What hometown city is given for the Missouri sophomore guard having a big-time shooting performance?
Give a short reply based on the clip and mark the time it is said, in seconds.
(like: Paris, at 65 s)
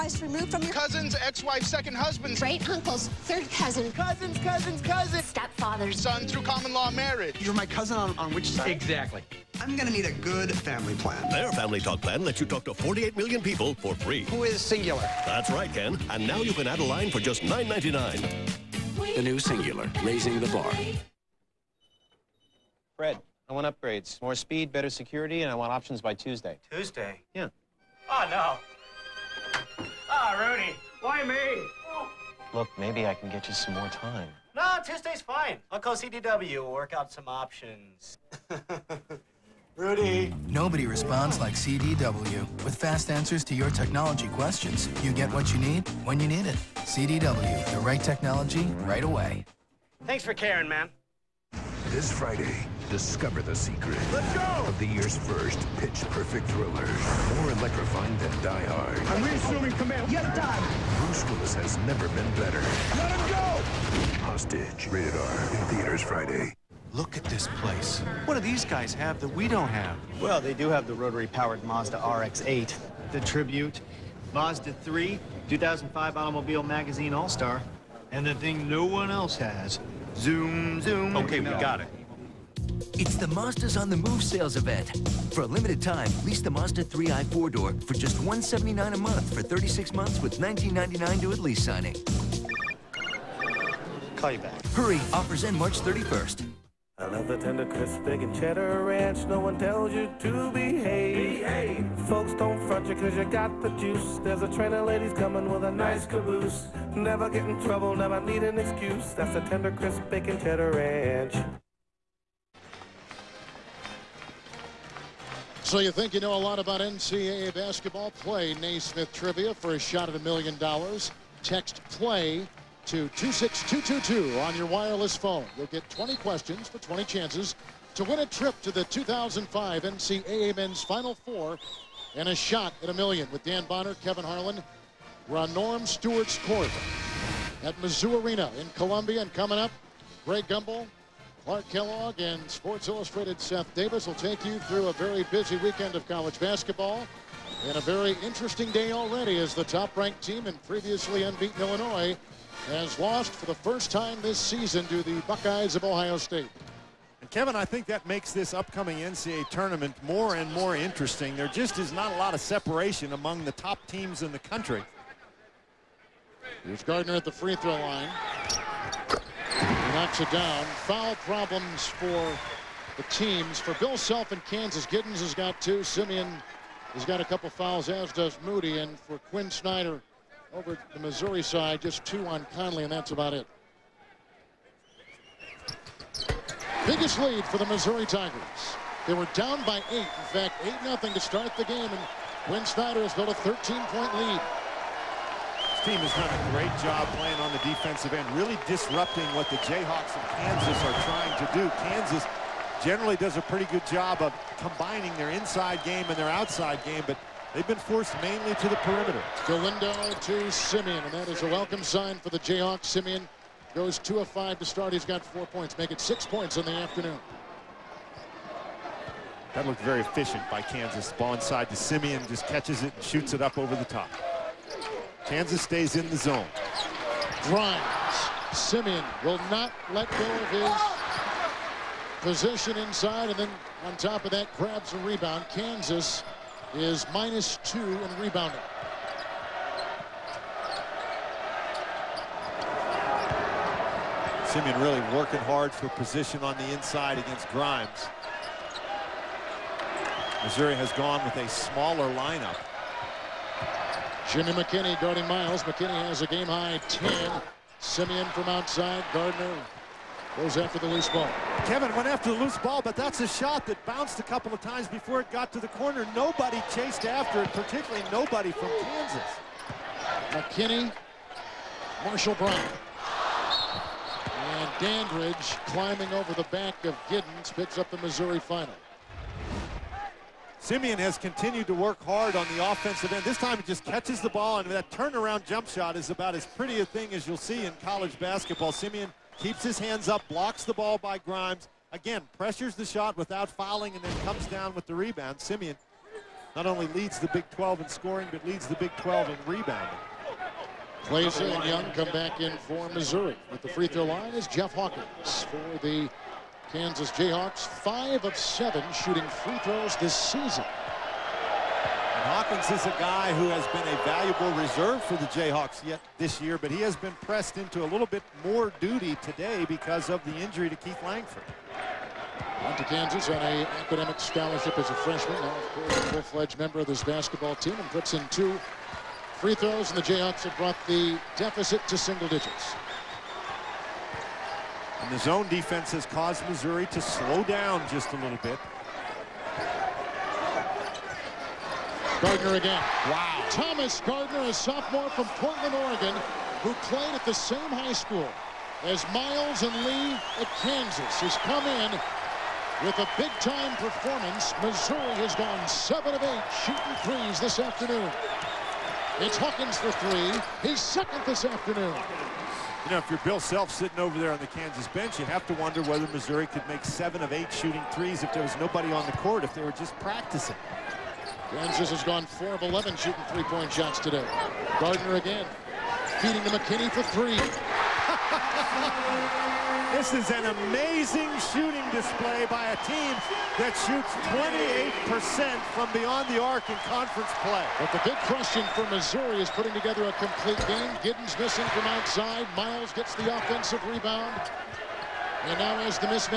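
Portland, Oregon, at 345 s.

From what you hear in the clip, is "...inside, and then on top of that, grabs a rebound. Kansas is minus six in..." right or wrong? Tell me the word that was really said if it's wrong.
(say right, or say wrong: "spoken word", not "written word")
wrong: "two", not "six".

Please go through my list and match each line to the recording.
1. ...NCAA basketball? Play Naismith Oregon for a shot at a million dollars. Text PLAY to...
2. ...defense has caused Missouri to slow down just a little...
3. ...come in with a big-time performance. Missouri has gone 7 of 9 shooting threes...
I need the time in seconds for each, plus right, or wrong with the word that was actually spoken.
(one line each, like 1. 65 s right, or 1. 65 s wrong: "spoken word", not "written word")
1. 116 s wrong: "Trivia", not "Oregon"
2. 335 s right
3. 351 s wrong: "8", not "9".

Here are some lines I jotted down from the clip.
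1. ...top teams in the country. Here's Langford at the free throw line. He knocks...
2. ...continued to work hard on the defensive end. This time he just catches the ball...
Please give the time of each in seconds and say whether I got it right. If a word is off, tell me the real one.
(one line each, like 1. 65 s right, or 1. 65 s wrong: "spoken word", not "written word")
1. 163 s wrong: "Gardner", not "Langford"
2. 281 s wrong: "offensive", not "defensive".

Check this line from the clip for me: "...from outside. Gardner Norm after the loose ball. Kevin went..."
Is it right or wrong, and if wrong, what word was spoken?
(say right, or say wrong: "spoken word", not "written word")
wrong: "Goes", not "Norm".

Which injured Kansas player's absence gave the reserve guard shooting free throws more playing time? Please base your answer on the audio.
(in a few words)
Keith Langford.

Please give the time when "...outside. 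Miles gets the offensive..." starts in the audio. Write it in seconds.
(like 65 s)
391 s.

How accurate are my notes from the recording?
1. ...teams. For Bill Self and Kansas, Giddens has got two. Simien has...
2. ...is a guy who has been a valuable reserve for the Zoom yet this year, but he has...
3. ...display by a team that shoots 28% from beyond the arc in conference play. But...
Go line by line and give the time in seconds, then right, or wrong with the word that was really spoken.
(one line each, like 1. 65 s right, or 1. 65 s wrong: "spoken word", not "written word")
1. 173 s right
2. 312 s wrong: "Jayhawks", not "Zoom"
3. 381 s right.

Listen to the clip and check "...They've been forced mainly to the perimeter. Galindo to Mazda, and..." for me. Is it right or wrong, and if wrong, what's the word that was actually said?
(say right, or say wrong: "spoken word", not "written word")
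wrong: "Simien", not "Mazda".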